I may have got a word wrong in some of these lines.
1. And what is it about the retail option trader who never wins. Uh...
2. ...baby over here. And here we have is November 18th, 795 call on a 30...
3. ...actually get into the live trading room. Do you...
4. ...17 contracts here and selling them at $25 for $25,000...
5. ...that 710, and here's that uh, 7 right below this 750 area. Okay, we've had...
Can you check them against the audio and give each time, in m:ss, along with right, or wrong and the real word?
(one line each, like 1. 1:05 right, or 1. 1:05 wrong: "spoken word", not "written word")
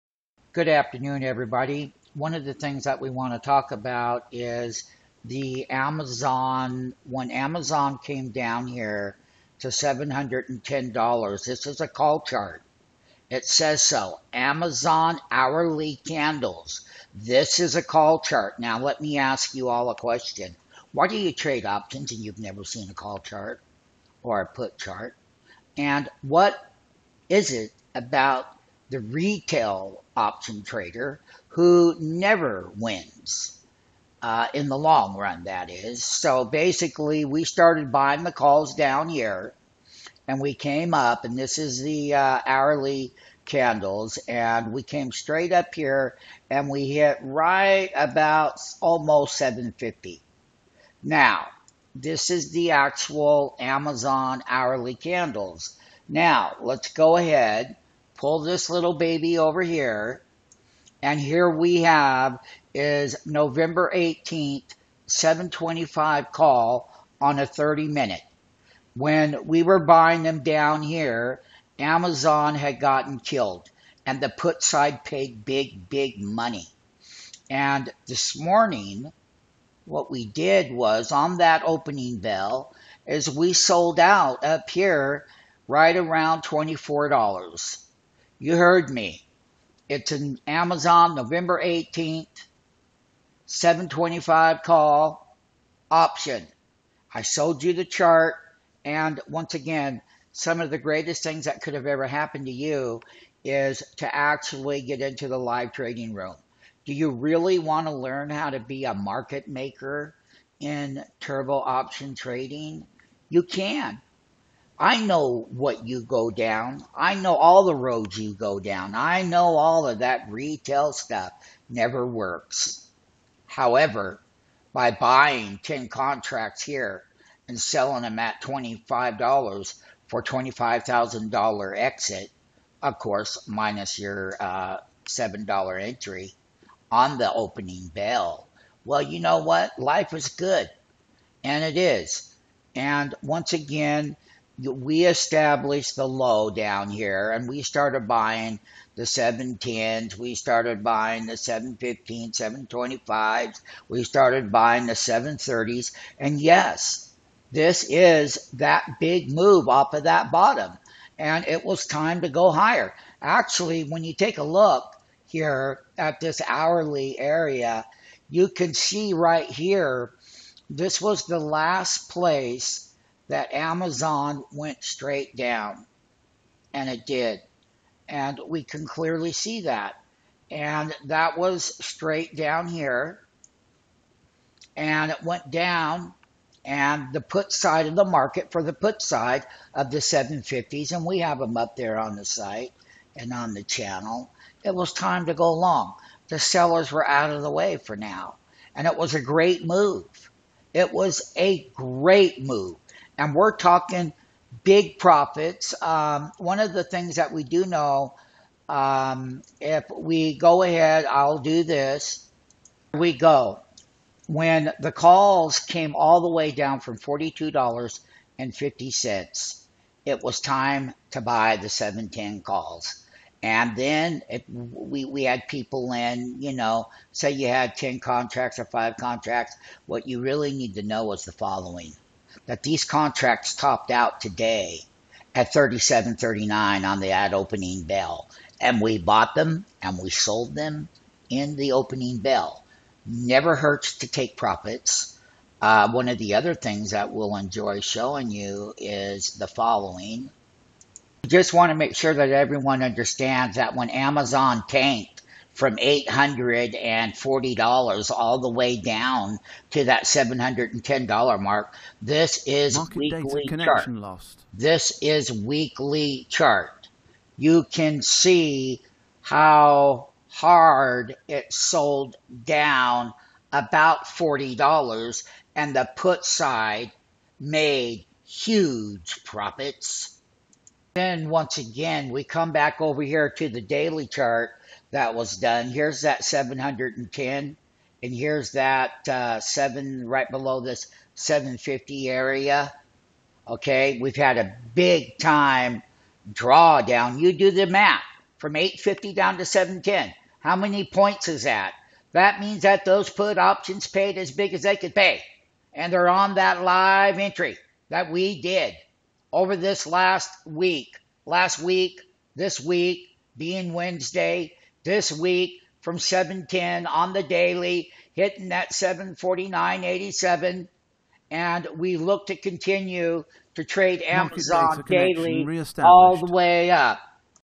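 1. 0:25 right
2. 0:58 wrong: "725", not "795"
3. 1:44 right
4. 2:05 wrong: "10", not "17"
5. 4:46 right.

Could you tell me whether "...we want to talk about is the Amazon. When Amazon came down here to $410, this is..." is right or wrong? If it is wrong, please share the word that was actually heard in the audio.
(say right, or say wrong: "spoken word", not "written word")
wrong: "710", not "410".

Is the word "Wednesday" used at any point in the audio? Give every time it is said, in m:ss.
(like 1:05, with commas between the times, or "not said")
5:13.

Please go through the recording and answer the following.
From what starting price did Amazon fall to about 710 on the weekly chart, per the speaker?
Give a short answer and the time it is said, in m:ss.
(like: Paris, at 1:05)
$840, at 4:15.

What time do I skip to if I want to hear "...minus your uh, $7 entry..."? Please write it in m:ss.
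2:13.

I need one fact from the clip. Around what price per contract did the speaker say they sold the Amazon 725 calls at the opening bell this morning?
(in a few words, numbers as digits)
$24.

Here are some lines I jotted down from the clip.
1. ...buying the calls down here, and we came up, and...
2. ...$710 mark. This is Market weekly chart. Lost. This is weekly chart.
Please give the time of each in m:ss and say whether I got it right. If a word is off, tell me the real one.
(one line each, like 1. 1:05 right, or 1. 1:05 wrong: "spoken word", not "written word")
1. 0:37 right
2. 4:20 right.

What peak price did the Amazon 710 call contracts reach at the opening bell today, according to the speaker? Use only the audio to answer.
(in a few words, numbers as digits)
37.39.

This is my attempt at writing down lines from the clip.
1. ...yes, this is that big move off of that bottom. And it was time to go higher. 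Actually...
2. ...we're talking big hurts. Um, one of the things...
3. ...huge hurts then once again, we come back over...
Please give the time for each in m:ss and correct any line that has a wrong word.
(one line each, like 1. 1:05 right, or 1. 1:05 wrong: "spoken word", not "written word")
1. 2:36 right
2. 3:23 wrong: "profits", not "hurts"
3. 4:38 wrong: "profits", not "hurts".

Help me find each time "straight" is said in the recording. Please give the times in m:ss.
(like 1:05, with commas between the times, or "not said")
0:45, 2:54, 3:01.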